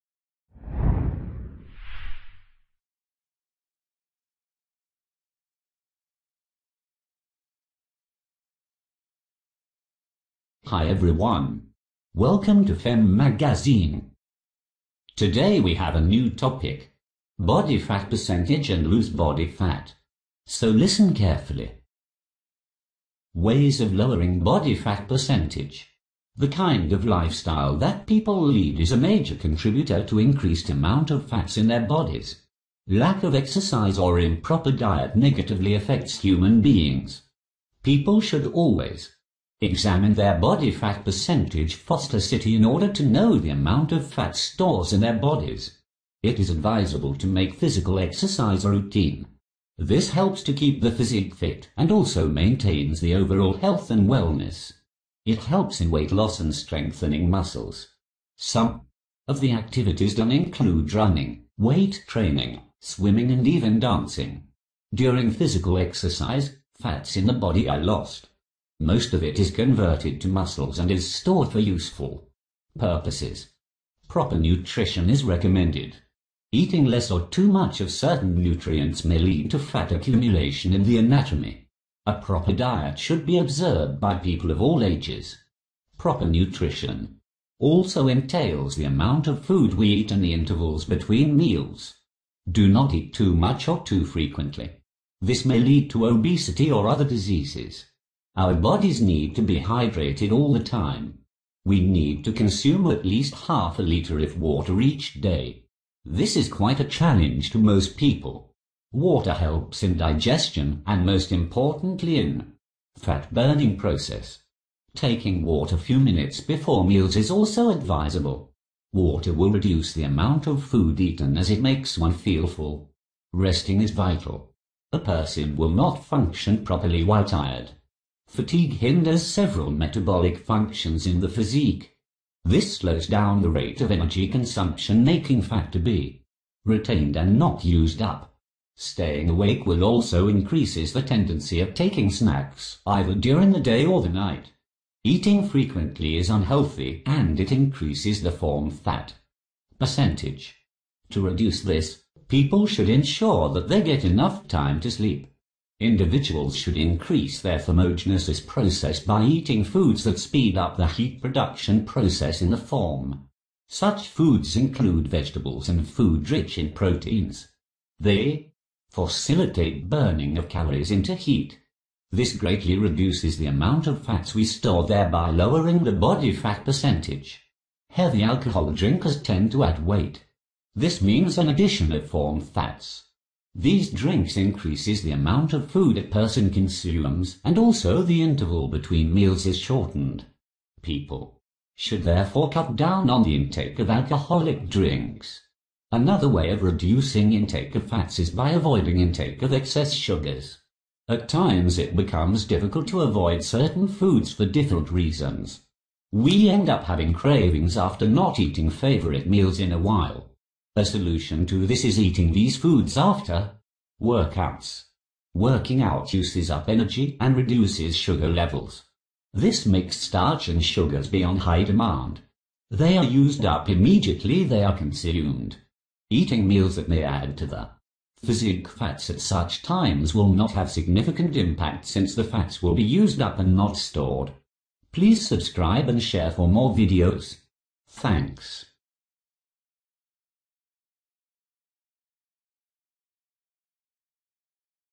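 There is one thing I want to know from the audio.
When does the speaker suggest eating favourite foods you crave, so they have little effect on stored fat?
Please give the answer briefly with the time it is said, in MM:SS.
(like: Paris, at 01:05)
after workouts, at 03:32.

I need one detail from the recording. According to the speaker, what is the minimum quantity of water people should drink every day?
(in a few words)
half a litre.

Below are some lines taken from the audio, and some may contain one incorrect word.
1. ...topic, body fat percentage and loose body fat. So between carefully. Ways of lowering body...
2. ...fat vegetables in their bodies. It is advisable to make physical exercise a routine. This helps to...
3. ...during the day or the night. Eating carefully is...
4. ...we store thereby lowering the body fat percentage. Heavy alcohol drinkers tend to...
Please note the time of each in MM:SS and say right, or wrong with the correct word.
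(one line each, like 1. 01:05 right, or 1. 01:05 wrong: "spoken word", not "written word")
1. 00:16 wrong: "listen", not "between"
2. 00:44 wrong: "stores", not "vegetables"
3. 02:23 wrong: "frequently", not "carefully"
4. 02:54 right.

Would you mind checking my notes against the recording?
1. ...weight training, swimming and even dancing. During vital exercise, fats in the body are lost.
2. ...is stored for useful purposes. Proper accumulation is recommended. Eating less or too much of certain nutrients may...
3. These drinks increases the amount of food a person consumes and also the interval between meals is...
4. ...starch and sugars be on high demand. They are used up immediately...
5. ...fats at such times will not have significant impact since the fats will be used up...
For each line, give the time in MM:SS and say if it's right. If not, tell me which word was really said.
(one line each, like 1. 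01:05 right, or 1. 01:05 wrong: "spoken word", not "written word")
1. 01:01 wrong: "physical", not "vital"
2. 01:10 wrong: "nutrition", not "accumulation"
3. 03:03 right
4. 03:39 right
5. 03:48 right.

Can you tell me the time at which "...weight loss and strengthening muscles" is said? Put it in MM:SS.
00:55.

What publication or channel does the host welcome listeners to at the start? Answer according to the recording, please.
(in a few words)
Fem Magazine.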